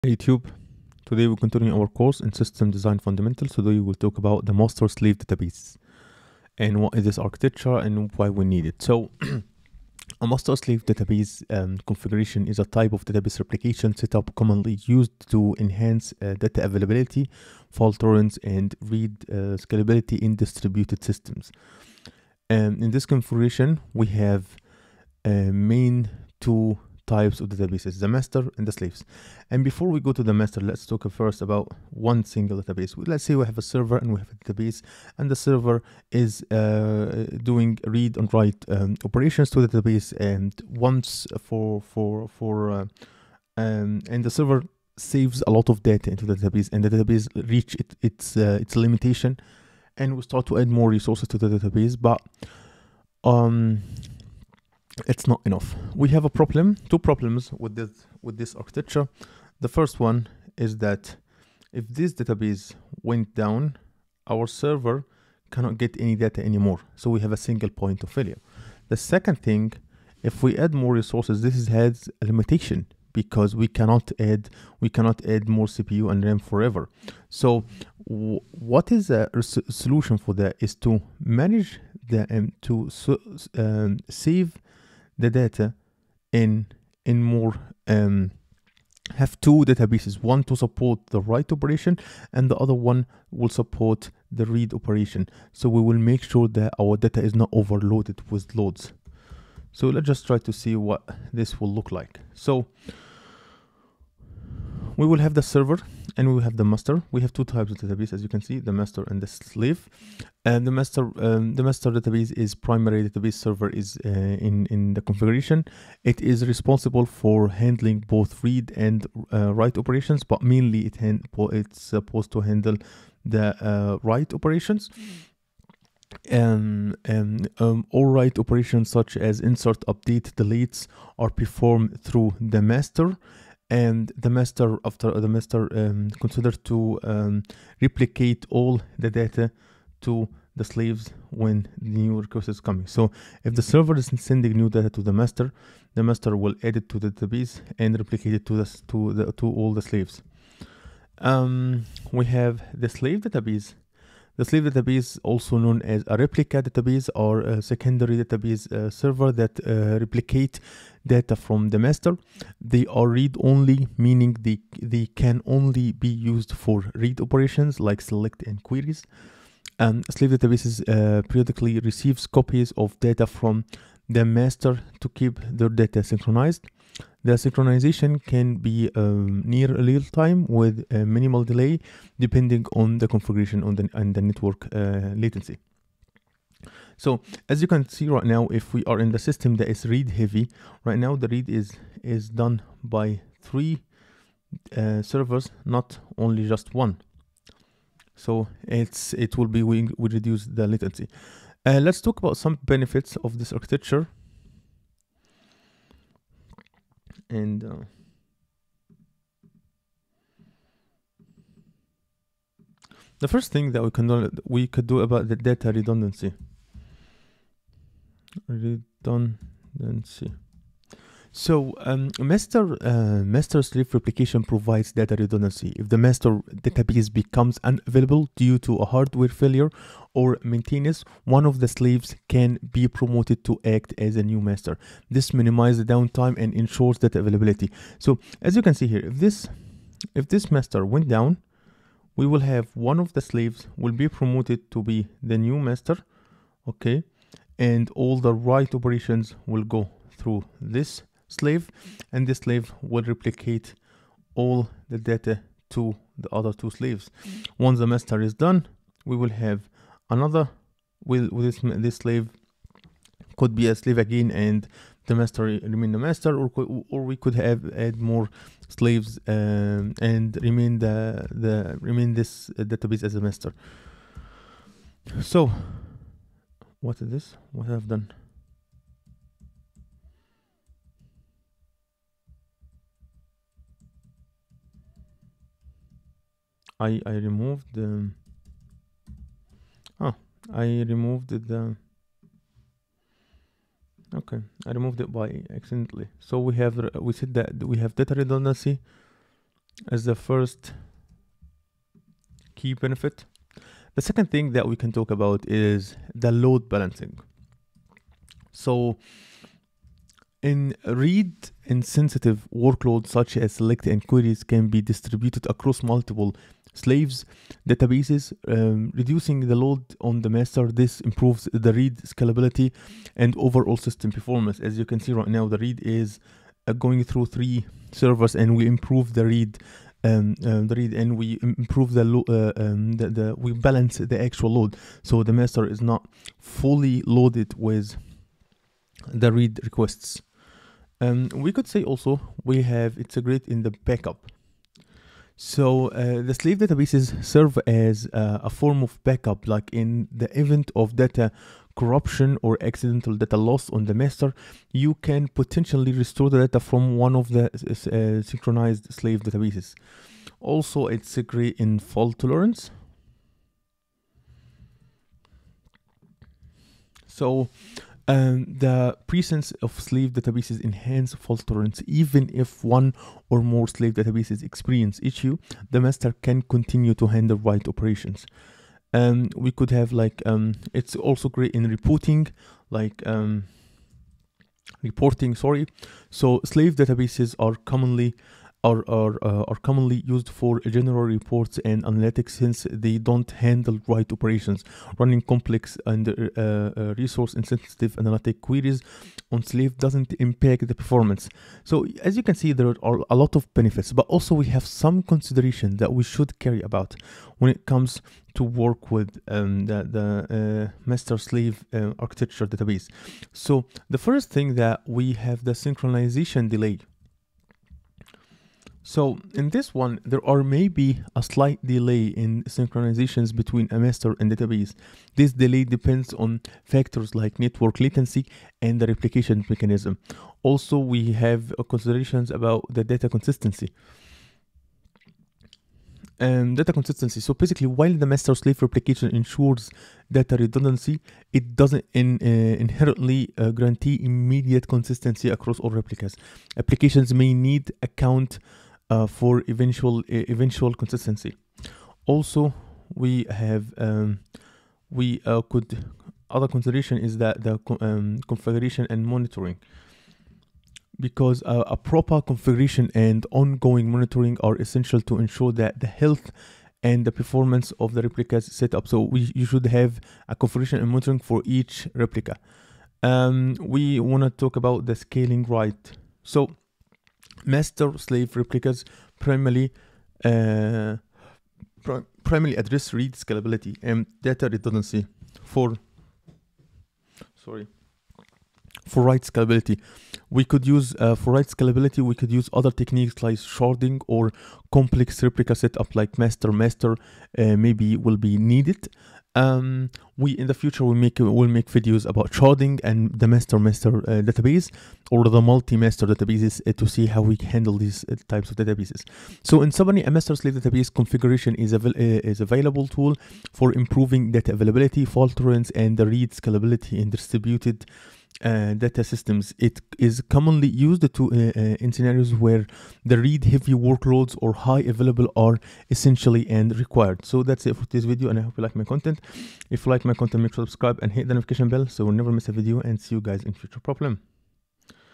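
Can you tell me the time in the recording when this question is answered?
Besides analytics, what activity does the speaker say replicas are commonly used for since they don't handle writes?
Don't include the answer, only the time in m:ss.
6:31.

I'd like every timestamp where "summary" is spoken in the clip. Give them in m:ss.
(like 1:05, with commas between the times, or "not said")
8:29.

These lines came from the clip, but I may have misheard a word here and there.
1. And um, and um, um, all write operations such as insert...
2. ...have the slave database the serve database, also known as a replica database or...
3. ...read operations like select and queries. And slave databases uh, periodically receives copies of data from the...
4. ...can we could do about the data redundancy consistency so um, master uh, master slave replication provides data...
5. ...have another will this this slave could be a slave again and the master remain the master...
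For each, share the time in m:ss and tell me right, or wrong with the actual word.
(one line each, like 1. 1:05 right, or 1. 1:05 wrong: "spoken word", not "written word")
1. 2:06 right
2. 2:32 wrong: "slave", not "serve"
3. 2:46 right
4. 3:33 wrong: "redundancy", not "consistency"
5. 4:19 right.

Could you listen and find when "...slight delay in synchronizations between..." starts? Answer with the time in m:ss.
7:01.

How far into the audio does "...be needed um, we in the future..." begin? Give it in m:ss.
8:18.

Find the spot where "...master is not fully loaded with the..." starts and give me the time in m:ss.
5:35.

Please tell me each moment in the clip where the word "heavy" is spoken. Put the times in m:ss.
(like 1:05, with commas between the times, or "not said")
3:10, 8:43.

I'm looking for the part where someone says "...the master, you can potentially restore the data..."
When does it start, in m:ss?
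5:53.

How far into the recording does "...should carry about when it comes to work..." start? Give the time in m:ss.
6:46.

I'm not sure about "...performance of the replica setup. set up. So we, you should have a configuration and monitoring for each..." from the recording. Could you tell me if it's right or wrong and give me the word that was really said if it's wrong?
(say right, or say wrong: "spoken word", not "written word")
right.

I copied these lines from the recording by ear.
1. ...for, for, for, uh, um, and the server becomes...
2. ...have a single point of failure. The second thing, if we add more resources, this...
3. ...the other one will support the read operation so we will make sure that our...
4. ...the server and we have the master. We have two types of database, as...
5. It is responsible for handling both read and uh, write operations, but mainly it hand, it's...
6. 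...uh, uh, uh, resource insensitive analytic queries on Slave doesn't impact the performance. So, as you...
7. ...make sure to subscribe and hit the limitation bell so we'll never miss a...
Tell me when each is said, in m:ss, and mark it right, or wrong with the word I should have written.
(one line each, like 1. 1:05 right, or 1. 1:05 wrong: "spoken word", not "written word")
1. 0:41 wrong: "saves", not "becomes"
2. 1:07 right
3. 1:32 right
4. 1:45 right
5. 1:56 right
6. 6:36 right
7. 8:50 wrong: "notification", not "limitation".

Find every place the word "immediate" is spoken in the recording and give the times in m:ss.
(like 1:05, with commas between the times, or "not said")
7:24.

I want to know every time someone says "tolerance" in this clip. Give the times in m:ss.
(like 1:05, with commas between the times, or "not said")
0:17, 6:02, 6:11, 8:35.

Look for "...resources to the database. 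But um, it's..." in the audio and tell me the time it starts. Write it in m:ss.
0:50.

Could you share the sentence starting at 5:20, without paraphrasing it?
This improves the read scalability and overall system performance.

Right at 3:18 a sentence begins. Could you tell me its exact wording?
So it's it will be we, we reduce the latency.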